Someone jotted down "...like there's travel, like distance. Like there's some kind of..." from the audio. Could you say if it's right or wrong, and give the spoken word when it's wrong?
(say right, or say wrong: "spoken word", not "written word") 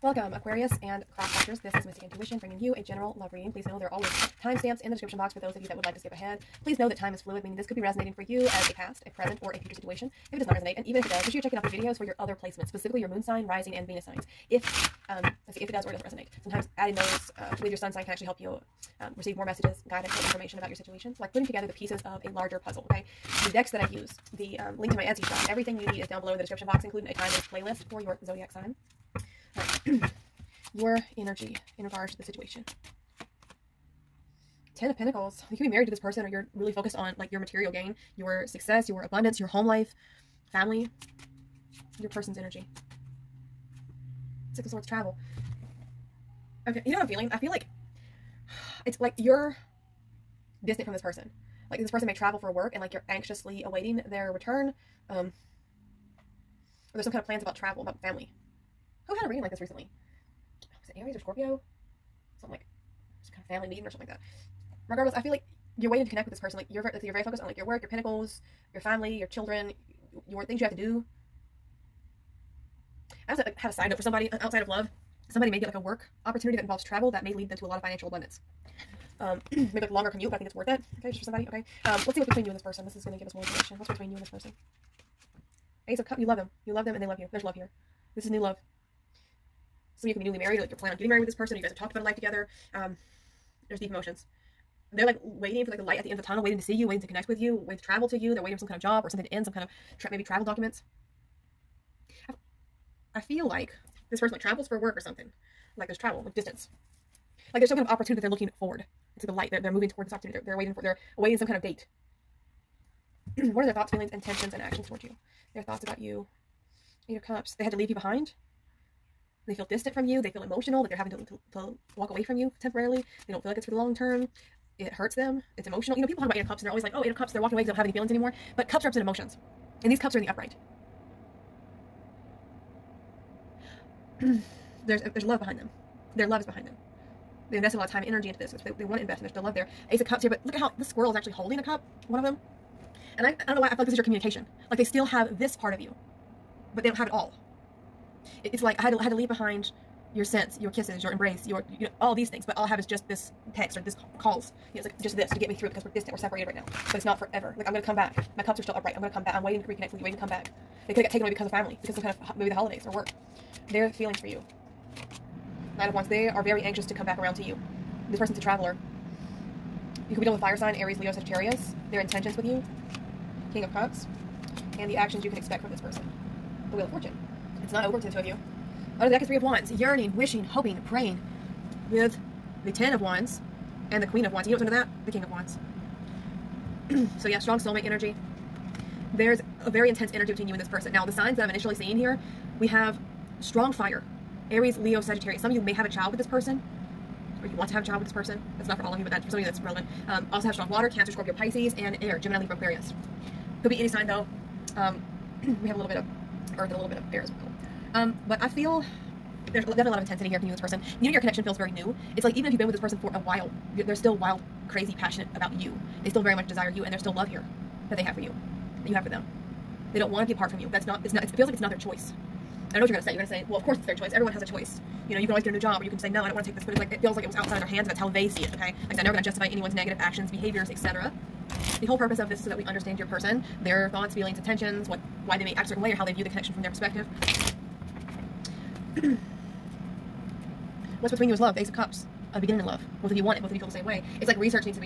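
right.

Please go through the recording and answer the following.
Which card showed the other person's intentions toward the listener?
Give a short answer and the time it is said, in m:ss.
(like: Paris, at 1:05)
King of Cups, at 2:53.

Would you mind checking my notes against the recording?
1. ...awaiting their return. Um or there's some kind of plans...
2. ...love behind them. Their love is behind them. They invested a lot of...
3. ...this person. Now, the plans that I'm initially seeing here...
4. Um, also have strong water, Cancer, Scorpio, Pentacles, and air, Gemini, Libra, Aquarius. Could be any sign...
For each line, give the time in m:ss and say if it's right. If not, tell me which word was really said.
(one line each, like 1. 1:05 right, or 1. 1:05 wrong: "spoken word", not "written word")
1. 0:53 right
2. 2:15 right
3. 3:10 wrong: "signs", not "plans"
4. 3:20 wrong: "Pisces", not "Pentacles".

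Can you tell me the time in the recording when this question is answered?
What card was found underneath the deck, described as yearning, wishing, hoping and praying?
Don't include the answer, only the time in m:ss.
2:59.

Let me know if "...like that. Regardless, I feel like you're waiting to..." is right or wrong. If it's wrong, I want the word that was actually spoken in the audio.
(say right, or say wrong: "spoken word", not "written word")
right.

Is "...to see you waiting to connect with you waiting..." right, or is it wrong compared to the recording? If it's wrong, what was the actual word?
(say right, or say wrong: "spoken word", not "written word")
right.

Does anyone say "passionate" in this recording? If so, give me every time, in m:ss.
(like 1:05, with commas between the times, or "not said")
3:34.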